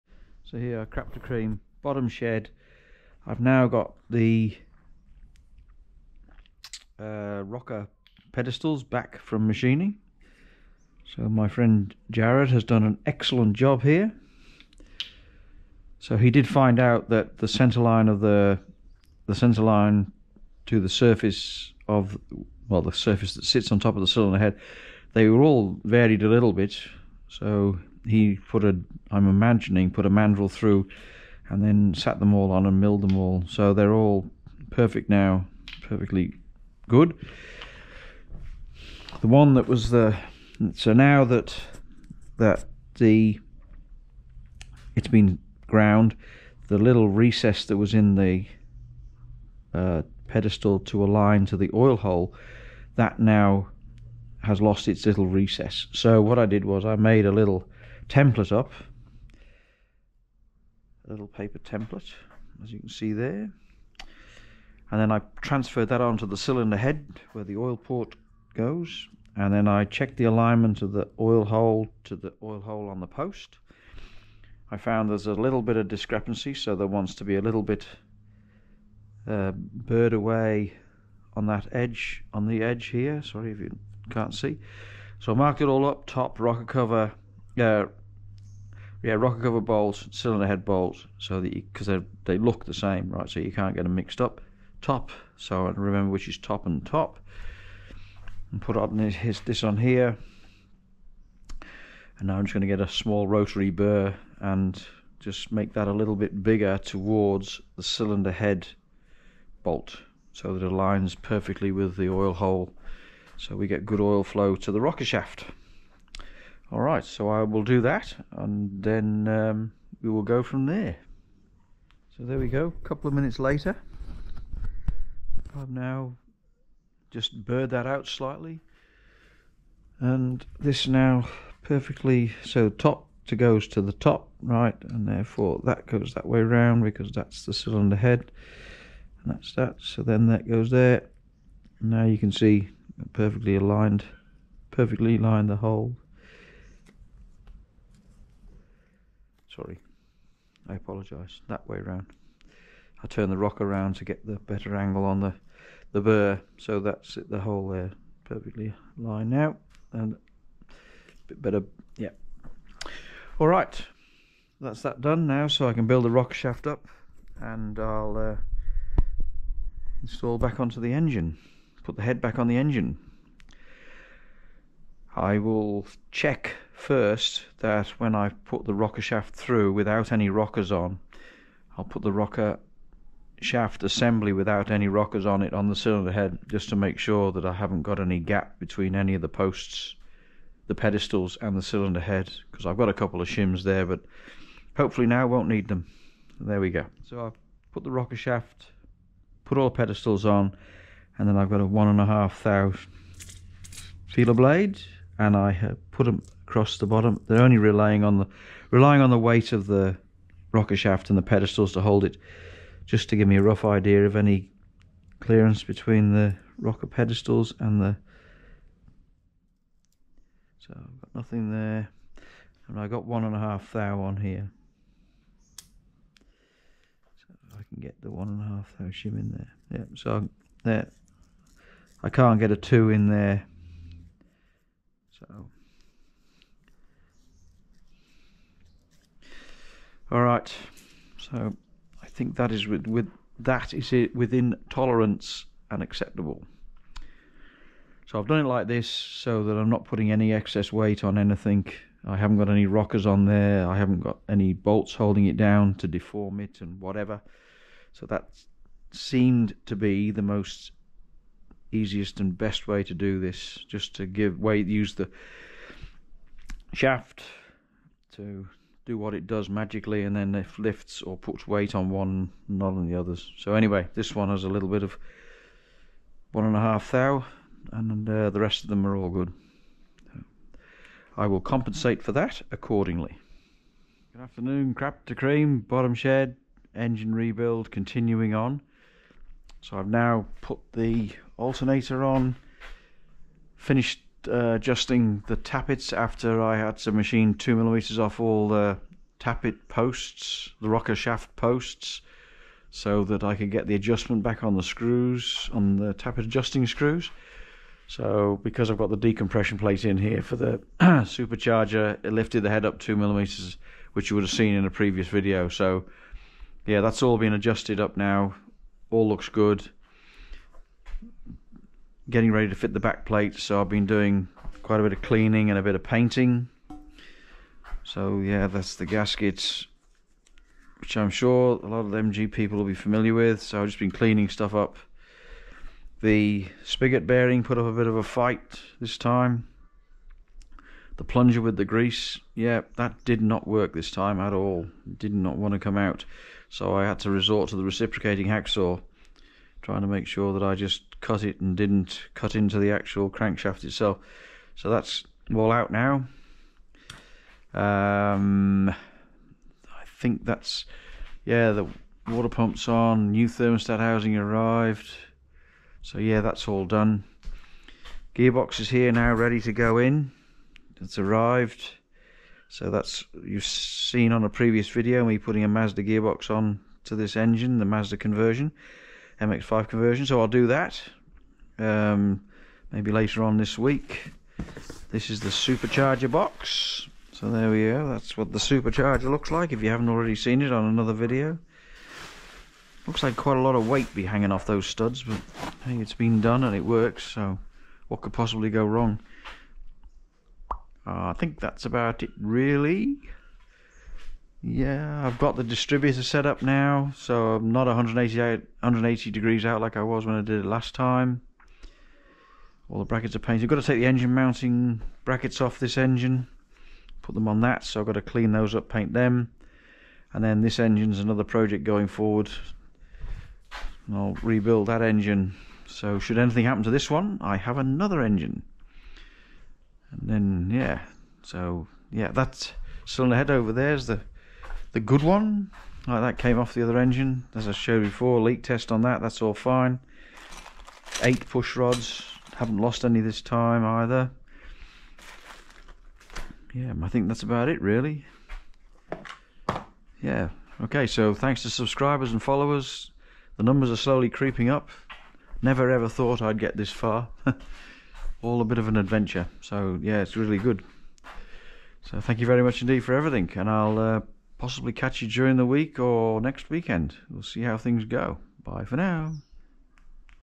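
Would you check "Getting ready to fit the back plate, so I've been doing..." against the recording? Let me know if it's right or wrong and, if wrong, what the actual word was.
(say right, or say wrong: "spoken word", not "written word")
right.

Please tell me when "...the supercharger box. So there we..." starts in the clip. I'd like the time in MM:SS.
06:25.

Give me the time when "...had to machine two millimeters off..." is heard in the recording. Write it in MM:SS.
04:56.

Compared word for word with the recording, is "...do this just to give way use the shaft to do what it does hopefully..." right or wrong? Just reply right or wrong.
wrong.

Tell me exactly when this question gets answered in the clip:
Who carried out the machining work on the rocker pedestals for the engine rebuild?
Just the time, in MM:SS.
00:12.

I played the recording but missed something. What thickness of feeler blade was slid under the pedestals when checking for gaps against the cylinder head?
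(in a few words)
1.5 thou.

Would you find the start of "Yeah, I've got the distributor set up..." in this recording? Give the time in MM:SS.
06:44.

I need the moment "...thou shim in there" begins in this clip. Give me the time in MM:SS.
03:48.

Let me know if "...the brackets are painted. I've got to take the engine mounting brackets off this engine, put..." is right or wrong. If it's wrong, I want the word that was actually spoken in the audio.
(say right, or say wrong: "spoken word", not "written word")
right.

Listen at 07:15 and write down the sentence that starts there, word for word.
Like that came off the other engine, as I showed before.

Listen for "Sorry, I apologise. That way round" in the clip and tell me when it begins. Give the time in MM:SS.
02:29.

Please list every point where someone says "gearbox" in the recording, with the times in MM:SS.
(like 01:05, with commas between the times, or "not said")
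06:08, 06:15.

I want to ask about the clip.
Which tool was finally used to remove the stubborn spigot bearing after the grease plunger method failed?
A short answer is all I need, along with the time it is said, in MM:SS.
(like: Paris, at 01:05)
Reciprocating hacksaw, at 05:47.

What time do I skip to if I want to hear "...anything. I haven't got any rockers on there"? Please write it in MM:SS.
04:11.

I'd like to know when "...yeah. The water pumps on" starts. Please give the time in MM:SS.
06:01.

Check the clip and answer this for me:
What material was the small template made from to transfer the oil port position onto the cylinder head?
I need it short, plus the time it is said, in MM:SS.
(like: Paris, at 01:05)
Paper, at 01:01.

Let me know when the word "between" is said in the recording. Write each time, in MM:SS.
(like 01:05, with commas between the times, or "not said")
03:08, 03:35.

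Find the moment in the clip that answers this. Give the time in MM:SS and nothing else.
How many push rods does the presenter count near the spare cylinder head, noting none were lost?
07:21.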